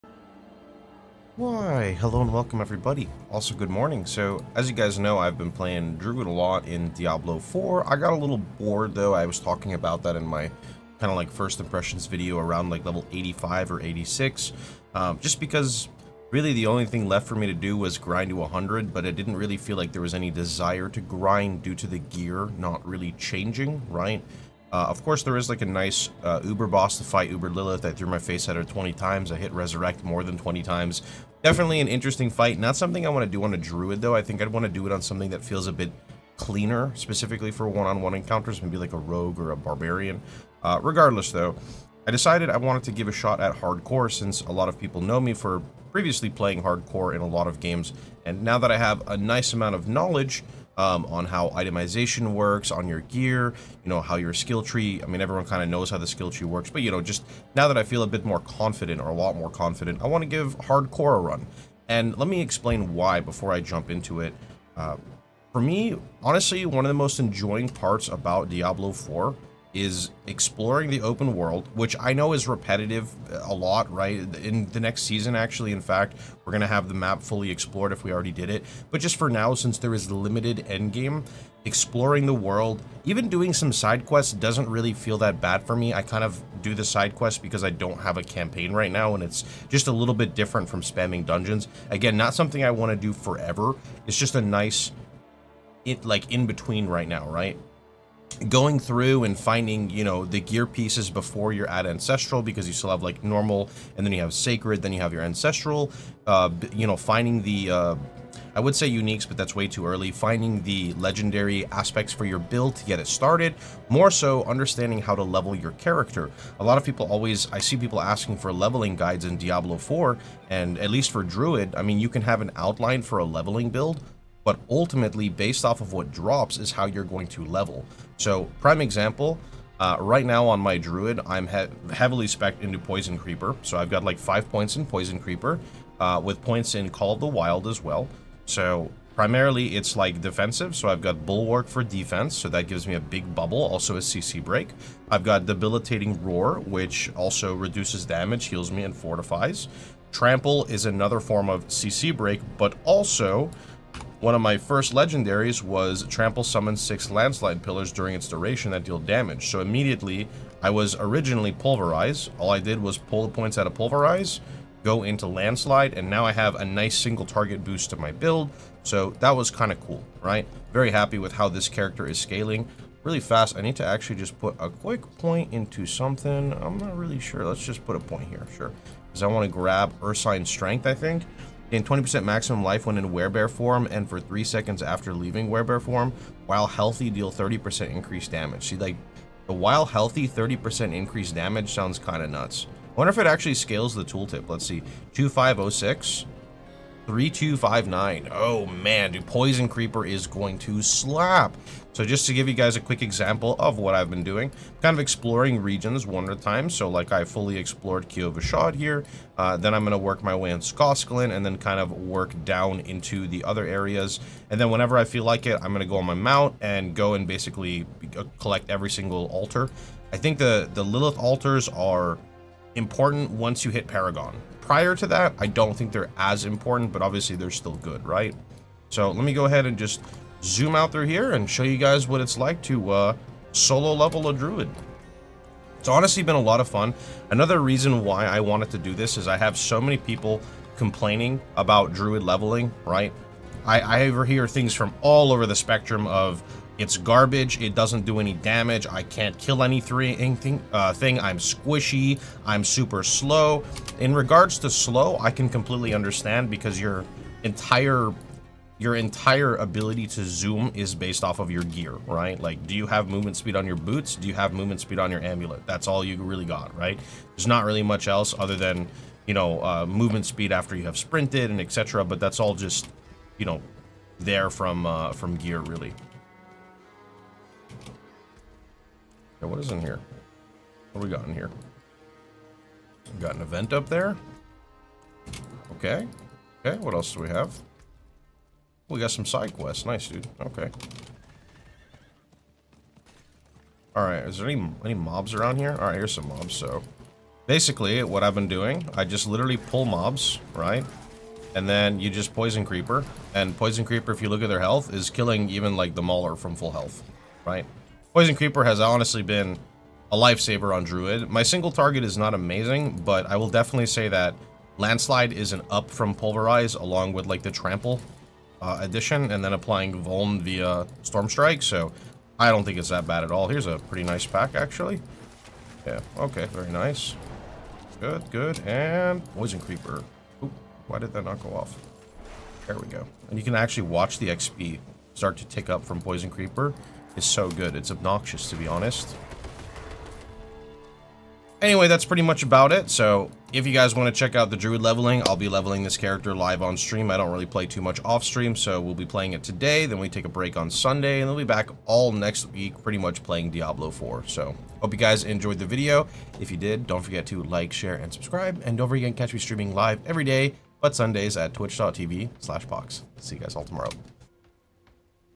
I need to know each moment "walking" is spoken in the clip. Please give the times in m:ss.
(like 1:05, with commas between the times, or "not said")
not said.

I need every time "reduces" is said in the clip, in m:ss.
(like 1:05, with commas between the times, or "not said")
2:27.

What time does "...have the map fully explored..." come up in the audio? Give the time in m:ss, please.
1:16.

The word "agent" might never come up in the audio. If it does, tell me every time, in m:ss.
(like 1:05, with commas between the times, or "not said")
not said.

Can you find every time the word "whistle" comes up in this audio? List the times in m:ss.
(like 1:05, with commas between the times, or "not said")
not said.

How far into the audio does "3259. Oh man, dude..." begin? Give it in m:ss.
3:17.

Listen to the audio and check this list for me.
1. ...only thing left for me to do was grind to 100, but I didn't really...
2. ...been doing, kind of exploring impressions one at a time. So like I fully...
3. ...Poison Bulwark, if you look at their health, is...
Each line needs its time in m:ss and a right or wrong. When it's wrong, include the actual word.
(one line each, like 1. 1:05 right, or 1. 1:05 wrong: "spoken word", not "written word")
1. 0:16 right
2. 3:24 wrong: "regions", not "impressions"
3. 5:03 wrong: "Creeper", not "Bulwark".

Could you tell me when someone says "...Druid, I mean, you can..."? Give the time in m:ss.
2:01.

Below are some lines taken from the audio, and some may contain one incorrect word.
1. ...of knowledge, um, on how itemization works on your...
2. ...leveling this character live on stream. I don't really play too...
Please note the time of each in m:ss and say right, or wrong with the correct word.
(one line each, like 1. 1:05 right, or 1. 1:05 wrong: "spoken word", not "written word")
1. 0:49 right
2. 5:45 right.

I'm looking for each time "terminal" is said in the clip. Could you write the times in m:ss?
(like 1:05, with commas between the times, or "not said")
not said.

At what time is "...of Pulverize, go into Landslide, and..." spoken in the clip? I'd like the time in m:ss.
2:43.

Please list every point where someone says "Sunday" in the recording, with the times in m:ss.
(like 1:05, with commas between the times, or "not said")
5:50, 6:00.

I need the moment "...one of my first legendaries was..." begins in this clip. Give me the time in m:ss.
2:34.